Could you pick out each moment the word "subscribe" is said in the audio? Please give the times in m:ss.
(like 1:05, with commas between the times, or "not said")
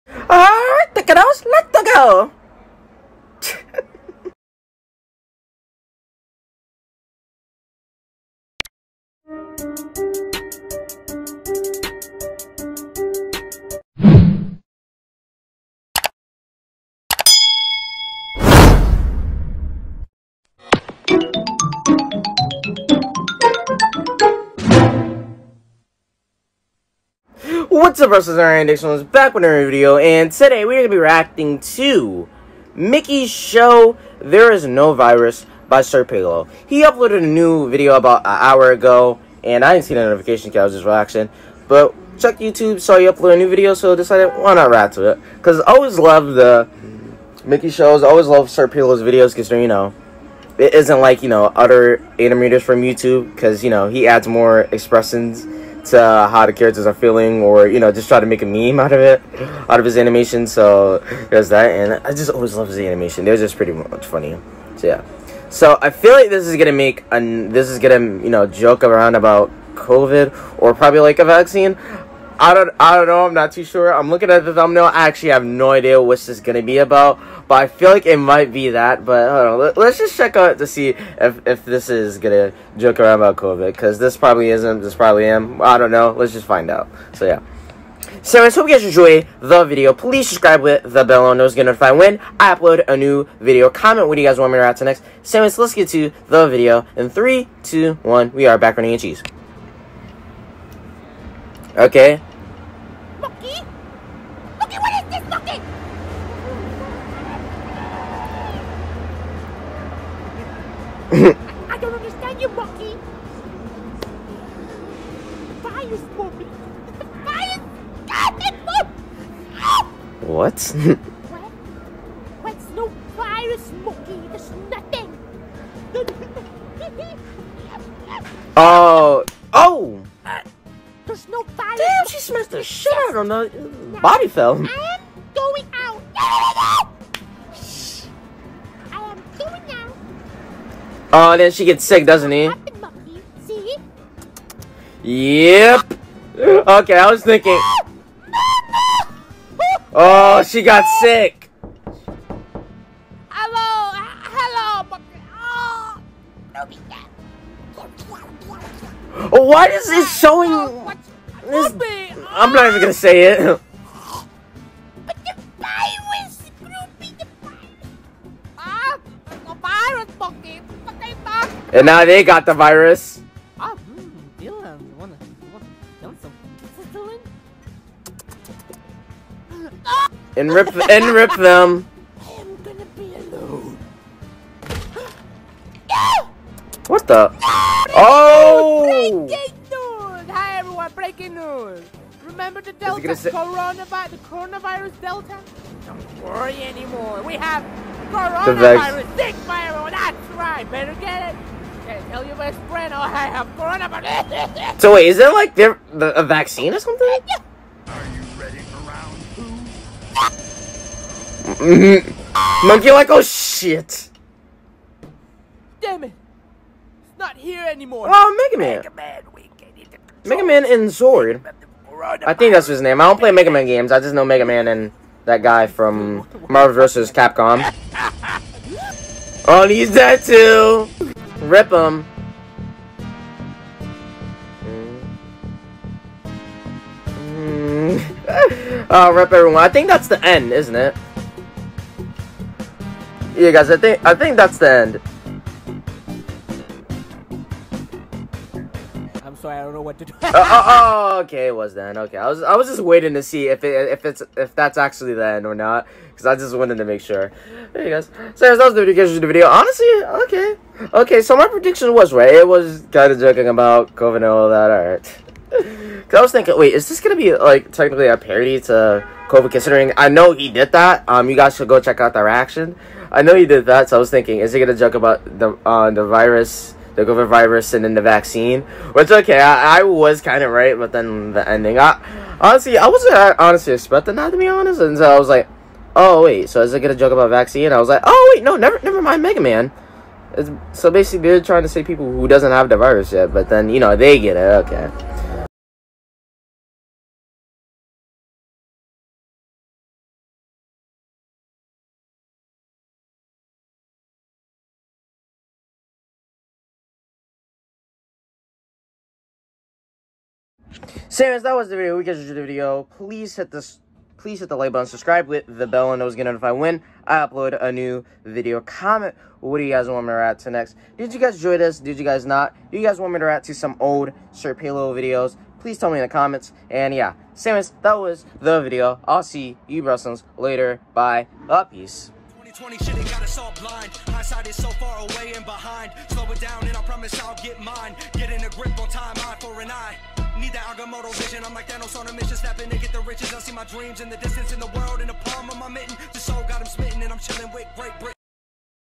1:30, 5:14.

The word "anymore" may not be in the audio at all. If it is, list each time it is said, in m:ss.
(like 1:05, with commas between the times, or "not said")
3:16, 3:37.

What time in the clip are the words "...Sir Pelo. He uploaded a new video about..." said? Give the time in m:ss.
0:35.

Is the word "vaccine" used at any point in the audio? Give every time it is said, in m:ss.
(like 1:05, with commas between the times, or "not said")
1:11, 3:26, 4:38, 4:47.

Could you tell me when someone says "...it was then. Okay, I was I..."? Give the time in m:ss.
4:11.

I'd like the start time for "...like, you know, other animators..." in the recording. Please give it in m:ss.
0:51.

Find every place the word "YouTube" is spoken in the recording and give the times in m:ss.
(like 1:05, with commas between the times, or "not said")
0:42, 0:52.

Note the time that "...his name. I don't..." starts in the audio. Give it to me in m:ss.
3:42.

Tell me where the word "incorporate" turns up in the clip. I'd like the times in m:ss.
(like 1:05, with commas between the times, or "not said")
not said.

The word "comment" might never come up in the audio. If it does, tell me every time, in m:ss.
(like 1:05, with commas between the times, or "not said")
1:33, 5:18, 5:26.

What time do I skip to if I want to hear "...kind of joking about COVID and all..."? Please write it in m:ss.
4:22.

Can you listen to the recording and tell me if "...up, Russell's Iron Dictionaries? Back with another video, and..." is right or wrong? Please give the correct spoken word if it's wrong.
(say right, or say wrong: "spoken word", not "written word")
right.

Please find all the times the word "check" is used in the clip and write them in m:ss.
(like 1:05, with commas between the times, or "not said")
0:42, 1:20, 4:31.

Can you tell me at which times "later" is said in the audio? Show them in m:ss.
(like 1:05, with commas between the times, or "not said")
5:30.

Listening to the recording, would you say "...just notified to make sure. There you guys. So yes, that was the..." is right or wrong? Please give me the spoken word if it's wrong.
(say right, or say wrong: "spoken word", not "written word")
wrong: "wanted", not "notified".